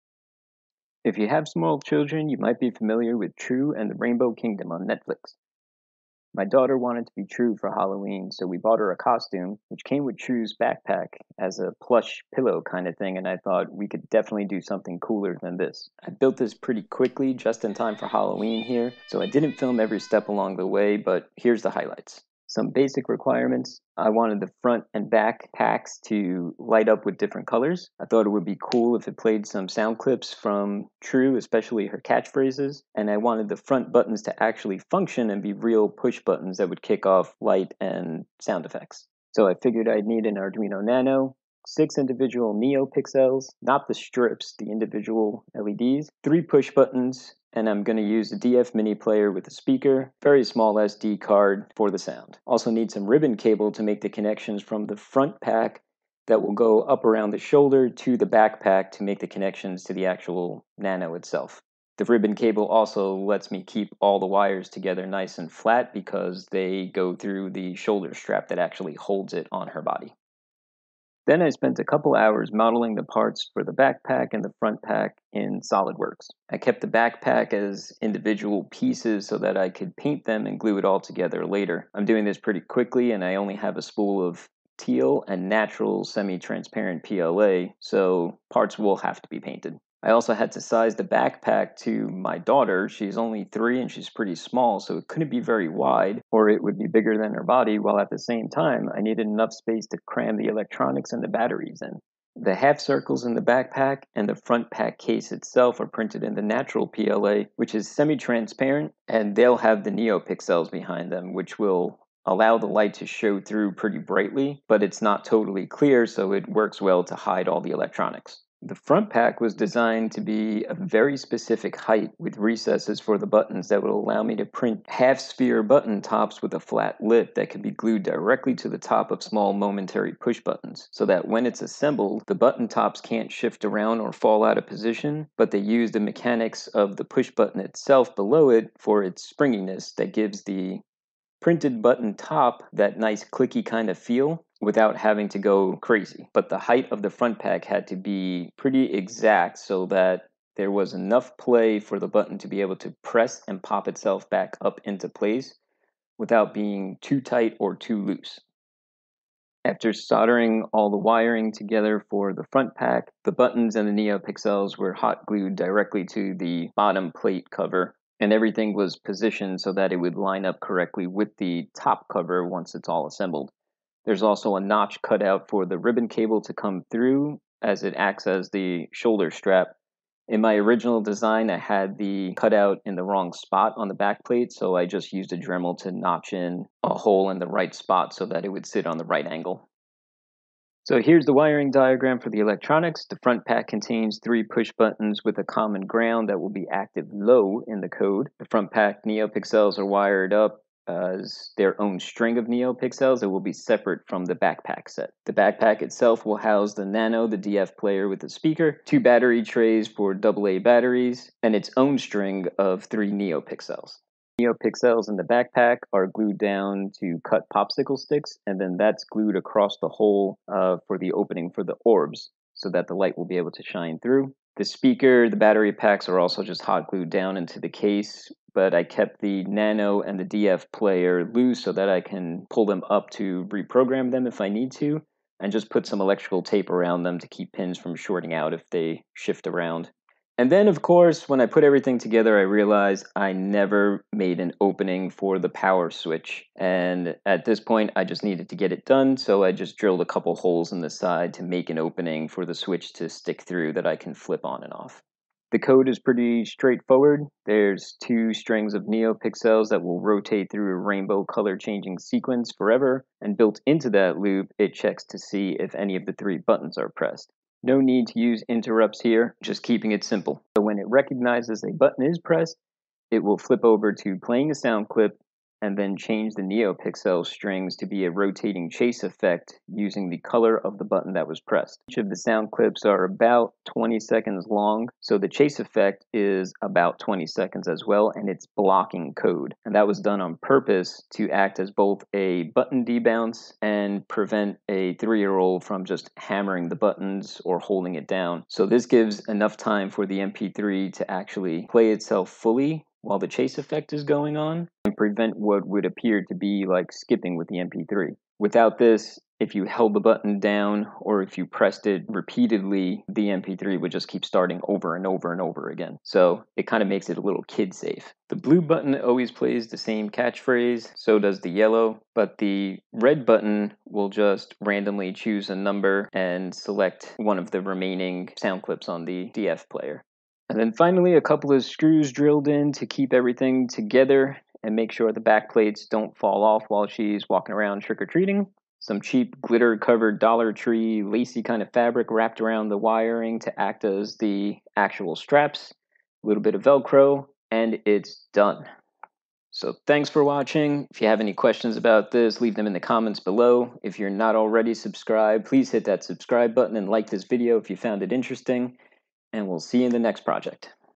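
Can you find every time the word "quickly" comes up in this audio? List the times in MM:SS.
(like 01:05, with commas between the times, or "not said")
00:16, 01:22.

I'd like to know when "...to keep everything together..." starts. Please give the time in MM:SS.
05:32.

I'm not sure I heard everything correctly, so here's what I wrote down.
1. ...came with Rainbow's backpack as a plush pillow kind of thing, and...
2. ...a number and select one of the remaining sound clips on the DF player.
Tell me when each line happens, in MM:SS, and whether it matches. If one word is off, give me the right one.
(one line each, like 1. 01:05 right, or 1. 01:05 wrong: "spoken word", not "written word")
1. 00:09 wrong: "True", not "Rainbow"
2. 05:25 right.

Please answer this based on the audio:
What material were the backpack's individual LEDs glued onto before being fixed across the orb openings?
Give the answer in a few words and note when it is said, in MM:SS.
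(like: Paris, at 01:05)
popsicle sticks, at 03:37.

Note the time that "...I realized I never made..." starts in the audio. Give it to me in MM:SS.
04:02.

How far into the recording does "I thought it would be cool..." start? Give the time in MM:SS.
00:28.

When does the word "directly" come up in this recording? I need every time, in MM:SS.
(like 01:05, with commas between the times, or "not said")
02:08, 02:45.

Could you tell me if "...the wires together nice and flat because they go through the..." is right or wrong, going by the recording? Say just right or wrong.
right.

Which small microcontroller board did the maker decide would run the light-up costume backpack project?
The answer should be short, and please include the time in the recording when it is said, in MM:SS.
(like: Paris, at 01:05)
Arduino Nano, at 00:40.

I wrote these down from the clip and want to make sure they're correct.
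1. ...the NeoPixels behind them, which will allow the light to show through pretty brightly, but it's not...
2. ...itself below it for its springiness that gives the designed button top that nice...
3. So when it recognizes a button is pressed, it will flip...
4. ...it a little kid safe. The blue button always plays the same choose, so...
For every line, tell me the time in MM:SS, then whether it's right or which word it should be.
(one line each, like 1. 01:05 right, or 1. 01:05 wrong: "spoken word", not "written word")
1. 01:49 right
2. 02:17 wrong: "printed", not "designed"
3. 04:30 right
4. 05:17 wrong: "catchphrase", not "choose".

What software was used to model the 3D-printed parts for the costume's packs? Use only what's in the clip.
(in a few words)
SolidWorks.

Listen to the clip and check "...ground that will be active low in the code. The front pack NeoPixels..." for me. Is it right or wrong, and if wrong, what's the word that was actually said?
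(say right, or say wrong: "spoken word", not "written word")
right.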